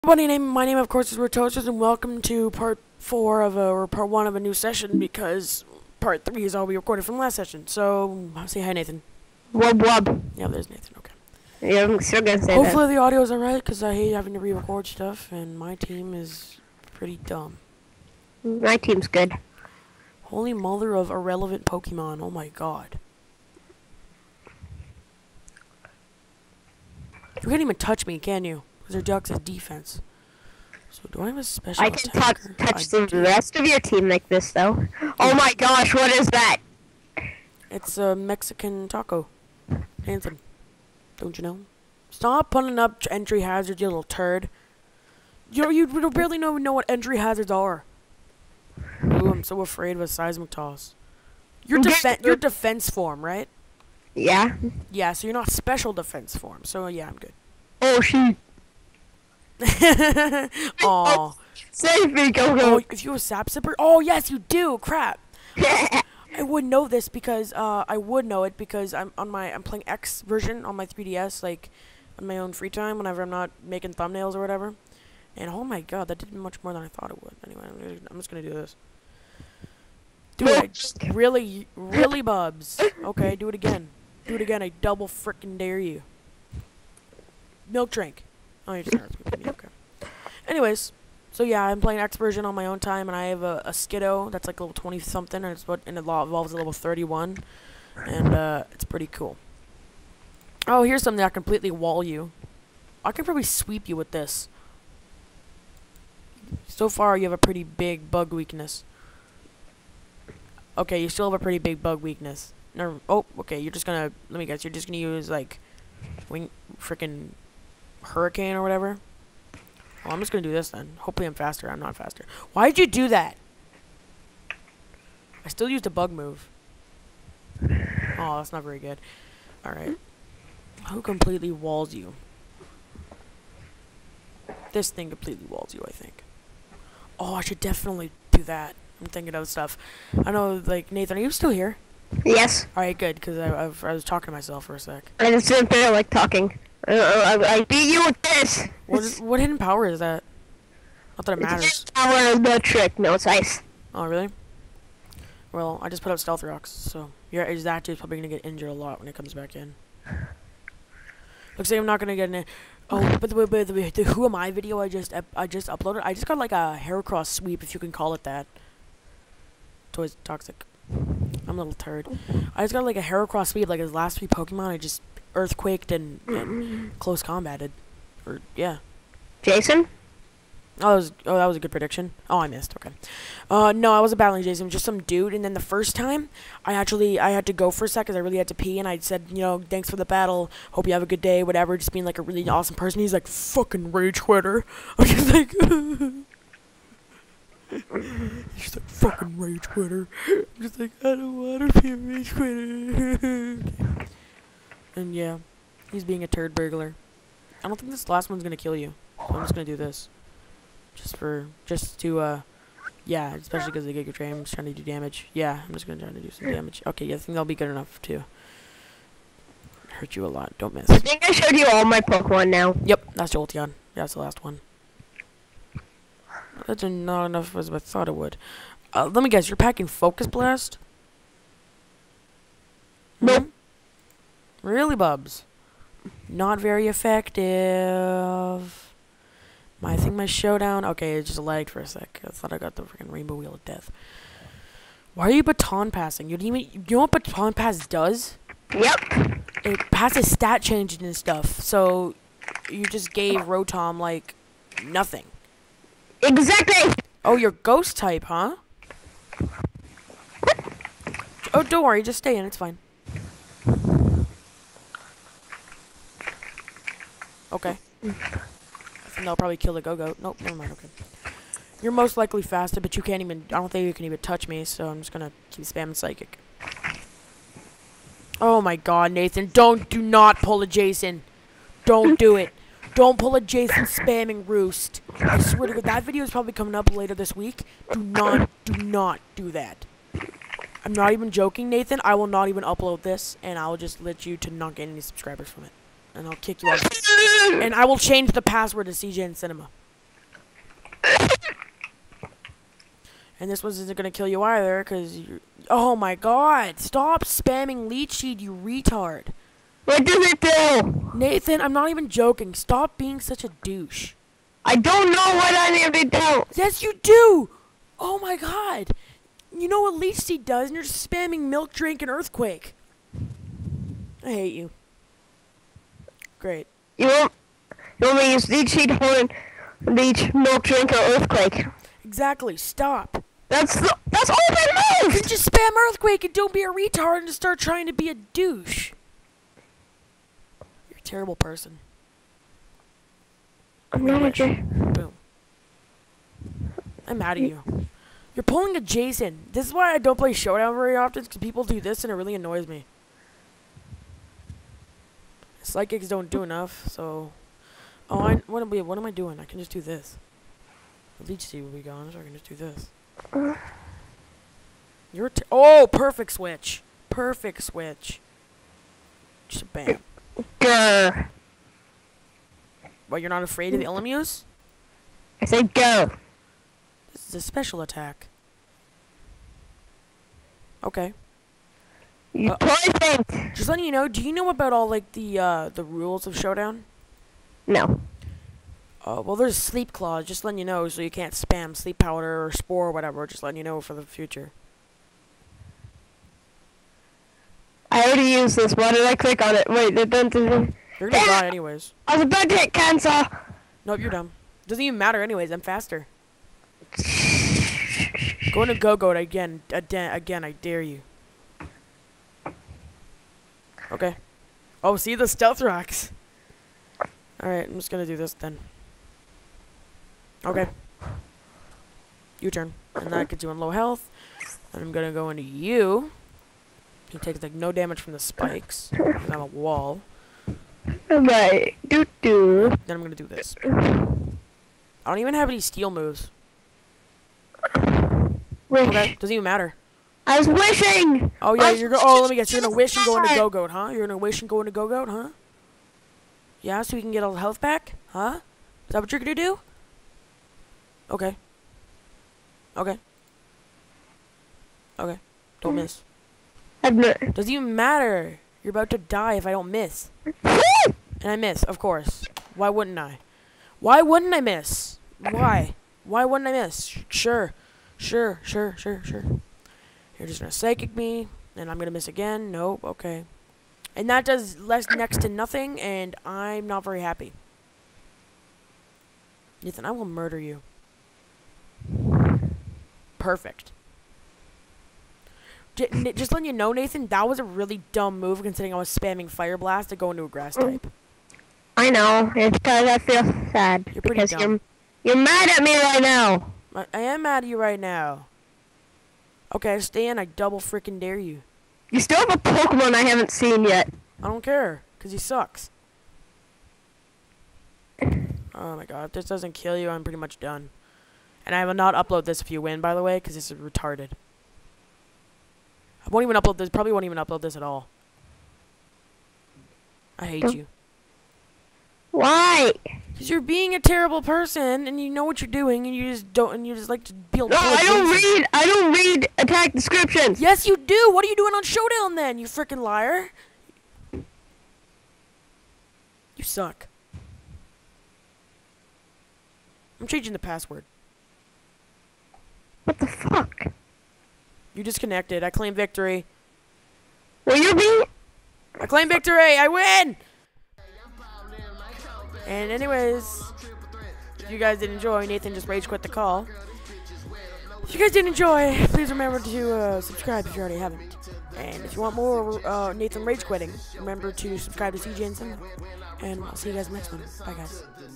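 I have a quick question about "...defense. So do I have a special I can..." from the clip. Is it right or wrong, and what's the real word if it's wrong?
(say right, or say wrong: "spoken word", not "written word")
right.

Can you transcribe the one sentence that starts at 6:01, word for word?
The leech seed will be gone, so I can just do this.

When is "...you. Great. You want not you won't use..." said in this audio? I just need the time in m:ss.
5:24.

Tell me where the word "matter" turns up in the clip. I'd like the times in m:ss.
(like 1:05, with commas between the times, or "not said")
2:31, 6:44, 7:19, 7:37.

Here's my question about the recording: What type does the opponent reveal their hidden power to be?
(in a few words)
Ice.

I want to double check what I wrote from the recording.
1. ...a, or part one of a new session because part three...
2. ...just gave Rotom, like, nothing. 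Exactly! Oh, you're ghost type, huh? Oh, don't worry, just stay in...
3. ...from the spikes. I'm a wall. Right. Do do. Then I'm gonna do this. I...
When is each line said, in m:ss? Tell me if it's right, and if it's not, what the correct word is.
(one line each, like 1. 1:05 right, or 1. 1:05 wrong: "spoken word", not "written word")
1. 0:03 right
2. 4:12 right
3. 7:07 right.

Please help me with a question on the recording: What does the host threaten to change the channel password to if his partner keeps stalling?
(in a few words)
CJNCinema.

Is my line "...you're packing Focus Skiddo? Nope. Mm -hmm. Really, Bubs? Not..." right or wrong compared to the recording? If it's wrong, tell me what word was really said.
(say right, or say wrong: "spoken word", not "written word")
wrong: "Blast", not "Skiddo".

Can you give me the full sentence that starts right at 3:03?
Uh, no, I wasn't battling Jason.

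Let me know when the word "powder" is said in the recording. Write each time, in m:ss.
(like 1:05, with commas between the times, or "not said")
6:31.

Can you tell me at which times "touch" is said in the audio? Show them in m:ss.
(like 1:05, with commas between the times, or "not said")
0:27, 0:32, 4:34.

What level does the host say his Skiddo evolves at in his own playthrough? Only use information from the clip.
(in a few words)
31.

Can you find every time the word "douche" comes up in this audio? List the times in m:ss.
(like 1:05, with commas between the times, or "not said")
5:13, 5:38.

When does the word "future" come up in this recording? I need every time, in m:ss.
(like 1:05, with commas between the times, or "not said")
6:34.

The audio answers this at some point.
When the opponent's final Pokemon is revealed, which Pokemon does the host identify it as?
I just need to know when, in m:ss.
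3:43.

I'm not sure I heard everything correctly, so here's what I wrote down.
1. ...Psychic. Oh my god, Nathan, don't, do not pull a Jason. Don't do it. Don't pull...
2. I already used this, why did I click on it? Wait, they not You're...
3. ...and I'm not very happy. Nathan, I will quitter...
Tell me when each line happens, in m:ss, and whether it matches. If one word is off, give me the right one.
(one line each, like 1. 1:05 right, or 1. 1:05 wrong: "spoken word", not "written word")
1. 4:35 right
2. 6:37 right
3. 7:55 wrong: "murder", not "quitter".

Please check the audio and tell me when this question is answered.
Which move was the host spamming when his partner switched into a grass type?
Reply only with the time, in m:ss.
8:09.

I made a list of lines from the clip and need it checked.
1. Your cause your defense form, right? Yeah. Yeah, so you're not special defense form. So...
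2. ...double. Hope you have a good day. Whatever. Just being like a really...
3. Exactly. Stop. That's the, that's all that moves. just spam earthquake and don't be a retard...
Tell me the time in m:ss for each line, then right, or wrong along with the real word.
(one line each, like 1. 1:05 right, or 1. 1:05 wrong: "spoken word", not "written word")
1. 0:51 wrong: "defense", not "cause"
2. 3:10 wrong: "battle", not "double"
3. 5:32 right.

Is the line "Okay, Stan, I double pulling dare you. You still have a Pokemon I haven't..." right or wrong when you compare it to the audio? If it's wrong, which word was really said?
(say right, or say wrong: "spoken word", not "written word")
wrong: "freaking", not "pulling".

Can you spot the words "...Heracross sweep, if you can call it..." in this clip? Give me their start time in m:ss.
2:46.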